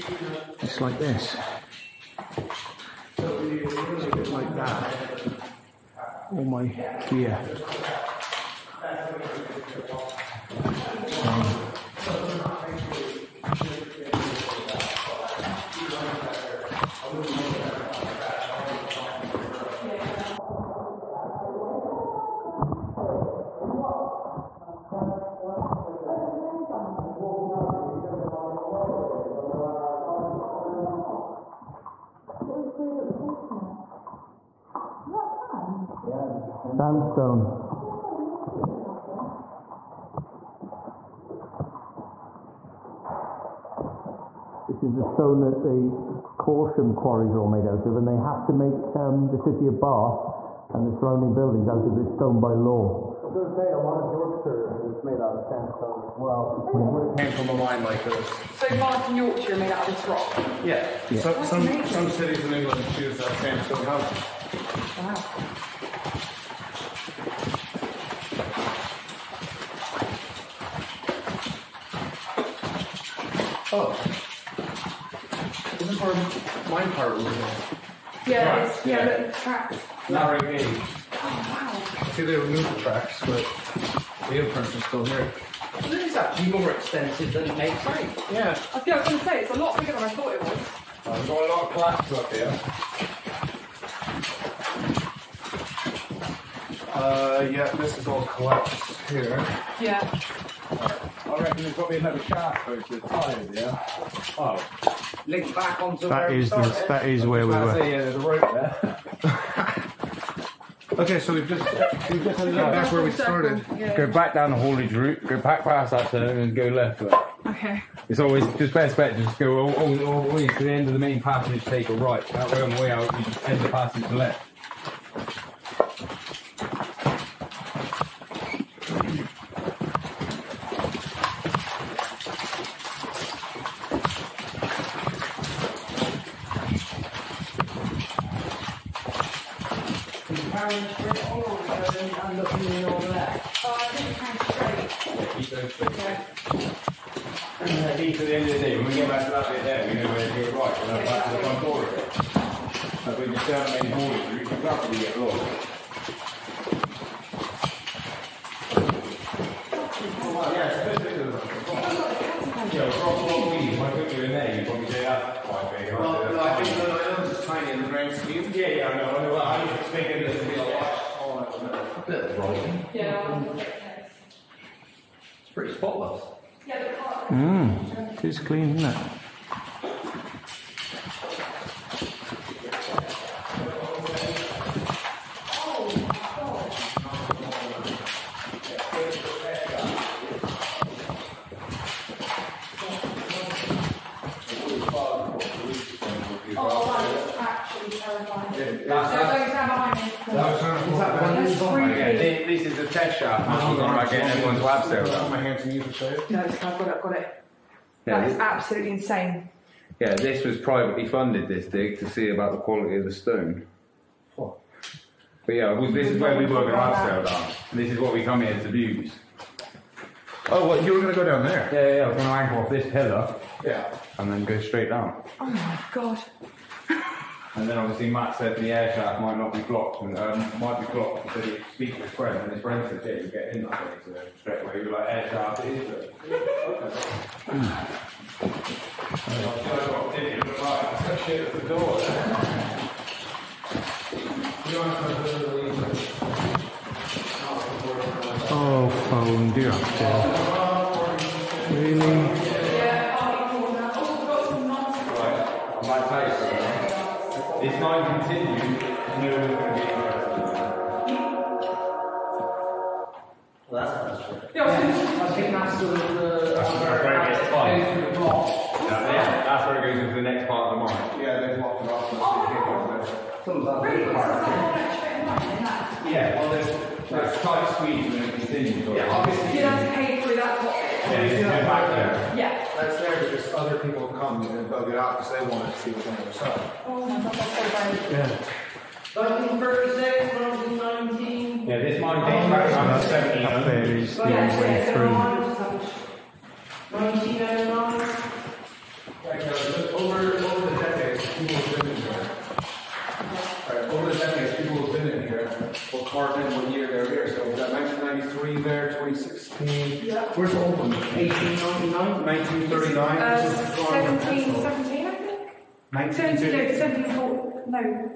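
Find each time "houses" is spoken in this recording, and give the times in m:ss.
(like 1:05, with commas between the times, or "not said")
1:03.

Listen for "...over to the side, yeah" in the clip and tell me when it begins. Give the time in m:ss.
1:42.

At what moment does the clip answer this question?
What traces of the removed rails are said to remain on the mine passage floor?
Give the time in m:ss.
1:24.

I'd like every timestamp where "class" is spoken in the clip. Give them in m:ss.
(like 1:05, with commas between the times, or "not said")
1:31.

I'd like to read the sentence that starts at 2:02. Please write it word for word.
That way on the way out, you just end the passage to left.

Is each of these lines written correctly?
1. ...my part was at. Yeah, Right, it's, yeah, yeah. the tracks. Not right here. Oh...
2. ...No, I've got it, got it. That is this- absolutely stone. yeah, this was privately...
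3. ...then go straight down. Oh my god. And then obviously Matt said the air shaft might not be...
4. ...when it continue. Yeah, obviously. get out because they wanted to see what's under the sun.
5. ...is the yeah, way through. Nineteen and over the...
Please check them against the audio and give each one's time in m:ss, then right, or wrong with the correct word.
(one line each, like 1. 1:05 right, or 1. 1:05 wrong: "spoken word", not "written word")
1. 1:16 right
2. 3:26 wrong: "insane", not "stone"
3. 3:44 right
4. 4:38 right
5. 4:53 right.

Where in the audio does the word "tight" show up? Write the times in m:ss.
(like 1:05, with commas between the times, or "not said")
4:27, 4:37.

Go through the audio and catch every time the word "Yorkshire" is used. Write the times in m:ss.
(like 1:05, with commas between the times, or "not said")
0:54, 0:59.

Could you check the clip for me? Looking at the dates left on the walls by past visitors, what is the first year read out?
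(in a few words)
1993.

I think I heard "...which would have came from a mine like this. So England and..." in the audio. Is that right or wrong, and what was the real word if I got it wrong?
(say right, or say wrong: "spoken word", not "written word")
wrong: "Bath", not "England".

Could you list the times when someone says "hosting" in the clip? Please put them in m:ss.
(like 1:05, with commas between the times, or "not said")
not said.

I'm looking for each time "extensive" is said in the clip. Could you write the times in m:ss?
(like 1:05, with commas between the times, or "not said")
1:26.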